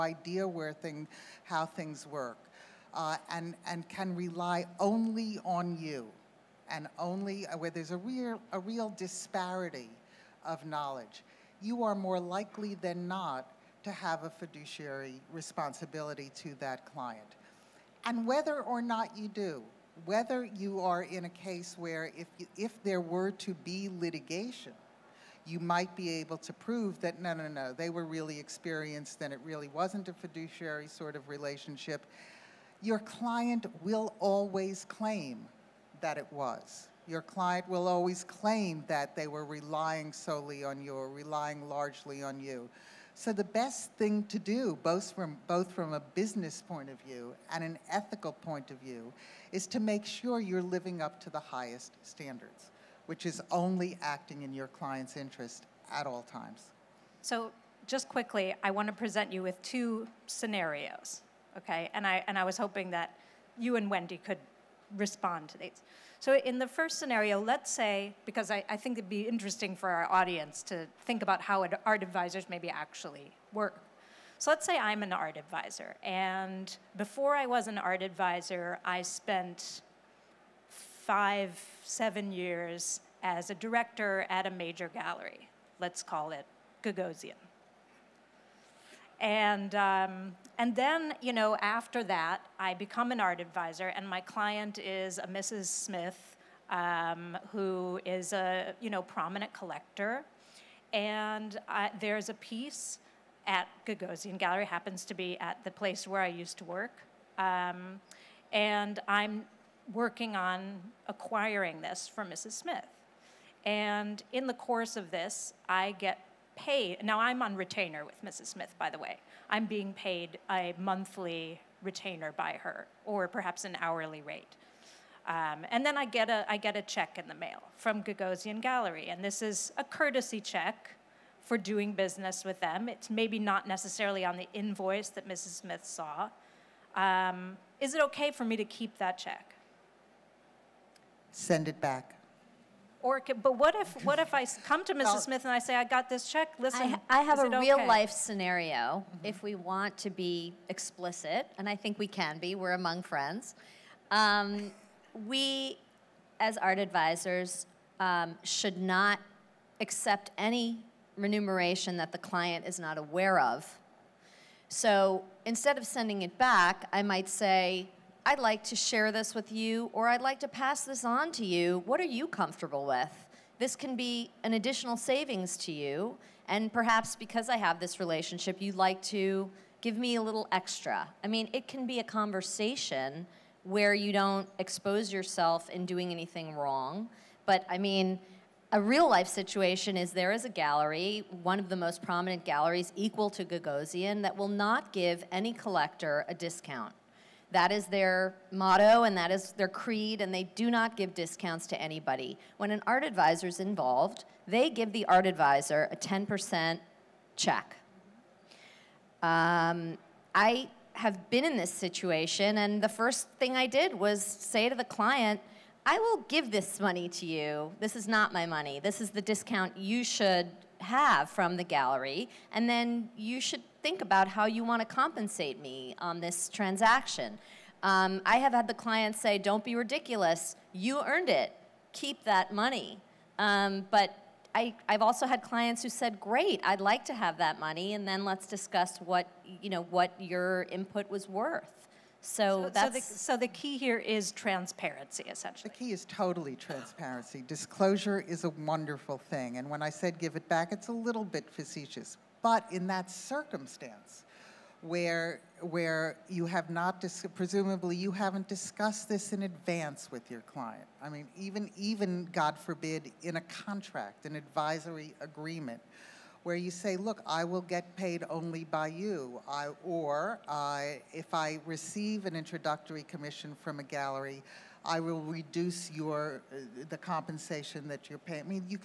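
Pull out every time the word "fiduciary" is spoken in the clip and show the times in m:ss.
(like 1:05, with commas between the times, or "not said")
0:14, 0:30.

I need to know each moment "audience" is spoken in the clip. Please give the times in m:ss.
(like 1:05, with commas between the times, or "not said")
1:10.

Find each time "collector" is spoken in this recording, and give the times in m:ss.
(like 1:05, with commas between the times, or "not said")
1:39, 3:15.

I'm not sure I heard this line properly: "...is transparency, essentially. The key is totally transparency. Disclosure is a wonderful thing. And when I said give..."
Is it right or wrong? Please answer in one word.
right.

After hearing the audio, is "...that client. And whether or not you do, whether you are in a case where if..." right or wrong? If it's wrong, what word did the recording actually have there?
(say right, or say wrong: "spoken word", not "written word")
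right.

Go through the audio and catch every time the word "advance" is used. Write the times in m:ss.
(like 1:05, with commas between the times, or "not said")
4:19.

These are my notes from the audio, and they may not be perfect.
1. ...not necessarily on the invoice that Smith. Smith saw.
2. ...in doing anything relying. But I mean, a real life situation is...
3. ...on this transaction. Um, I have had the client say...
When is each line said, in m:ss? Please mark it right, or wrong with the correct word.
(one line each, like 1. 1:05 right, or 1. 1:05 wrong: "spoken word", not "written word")
1. 2:13 wrong: "Mrs", not "Smith"
2. 3:05 wrong: "wrong", not "relying"
3. 3:45 right.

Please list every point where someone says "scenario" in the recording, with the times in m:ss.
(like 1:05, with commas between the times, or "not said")
1:00, 1:06, 2:28.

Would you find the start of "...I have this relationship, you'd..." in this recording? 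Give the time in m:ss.
2:57.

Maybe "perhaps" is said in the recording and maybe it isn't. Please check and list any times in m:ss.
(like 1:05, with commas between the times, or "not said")
2:03, 2:56.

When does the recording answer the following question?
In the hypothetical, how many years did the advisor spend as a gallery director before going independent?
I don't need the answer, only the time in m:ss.
1:20.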